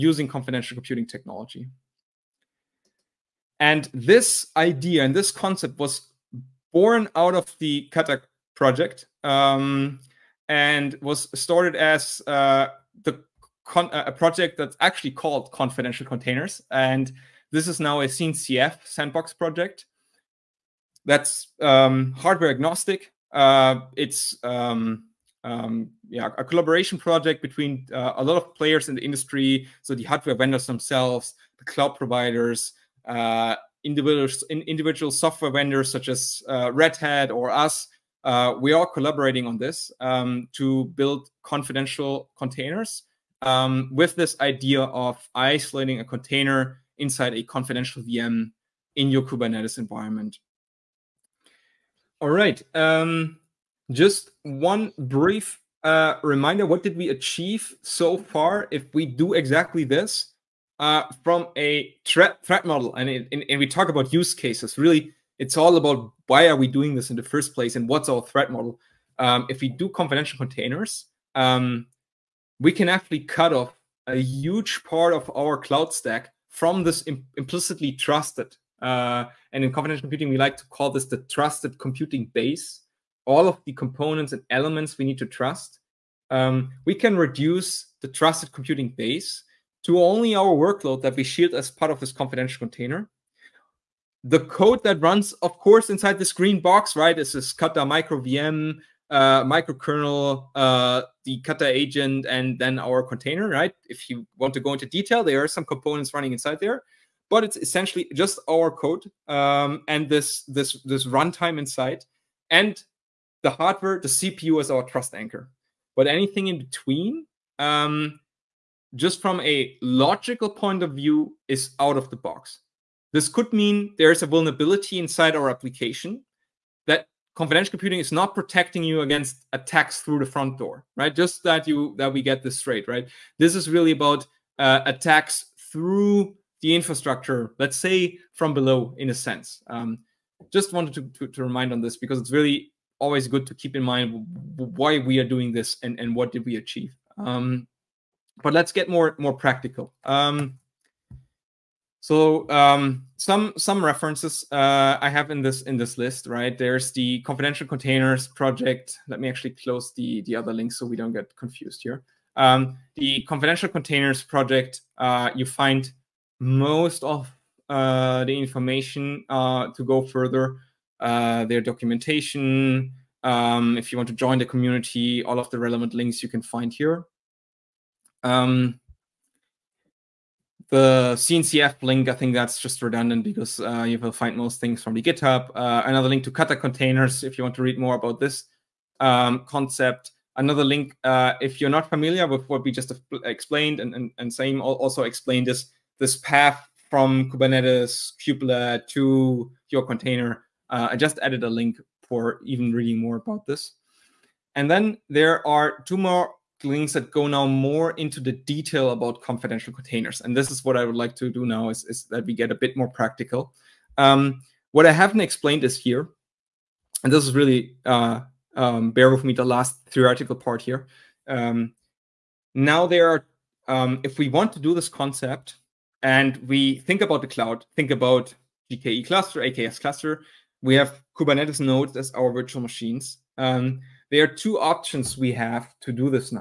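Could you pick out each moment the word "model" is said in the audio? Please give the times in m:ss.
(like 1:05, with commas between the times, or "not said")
1:02, 1:08.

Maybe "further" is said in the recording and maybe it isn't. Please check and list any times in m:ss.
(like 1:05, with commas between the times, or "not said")
2:50.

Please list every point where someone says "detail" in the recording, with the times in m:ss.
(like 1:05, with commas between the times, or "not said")
1:44, 3:28.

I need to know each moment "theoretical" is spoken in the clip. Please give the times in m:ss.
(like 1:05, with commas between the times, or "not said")
3:39.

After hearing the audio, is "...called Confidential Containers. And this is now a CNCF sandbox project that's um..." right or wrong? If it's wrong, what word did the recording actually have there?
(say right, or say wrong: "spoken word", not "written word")
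right.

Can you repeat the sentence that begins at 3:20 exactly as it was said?
Uh, I just added a link for even reading more about this.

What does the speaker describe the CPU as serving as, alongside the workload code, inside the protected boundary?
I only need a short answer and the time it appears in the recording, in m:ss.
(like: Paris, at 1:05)
trust anchor, at 1:54.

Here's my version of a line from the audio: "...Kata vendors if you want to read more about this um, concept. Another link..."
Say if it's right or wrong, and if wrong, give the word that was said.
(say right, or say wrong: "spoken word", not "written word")
wrong: "containers", not "vendors".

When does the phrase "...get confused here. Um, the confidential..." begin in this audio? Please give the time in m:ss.
2:41.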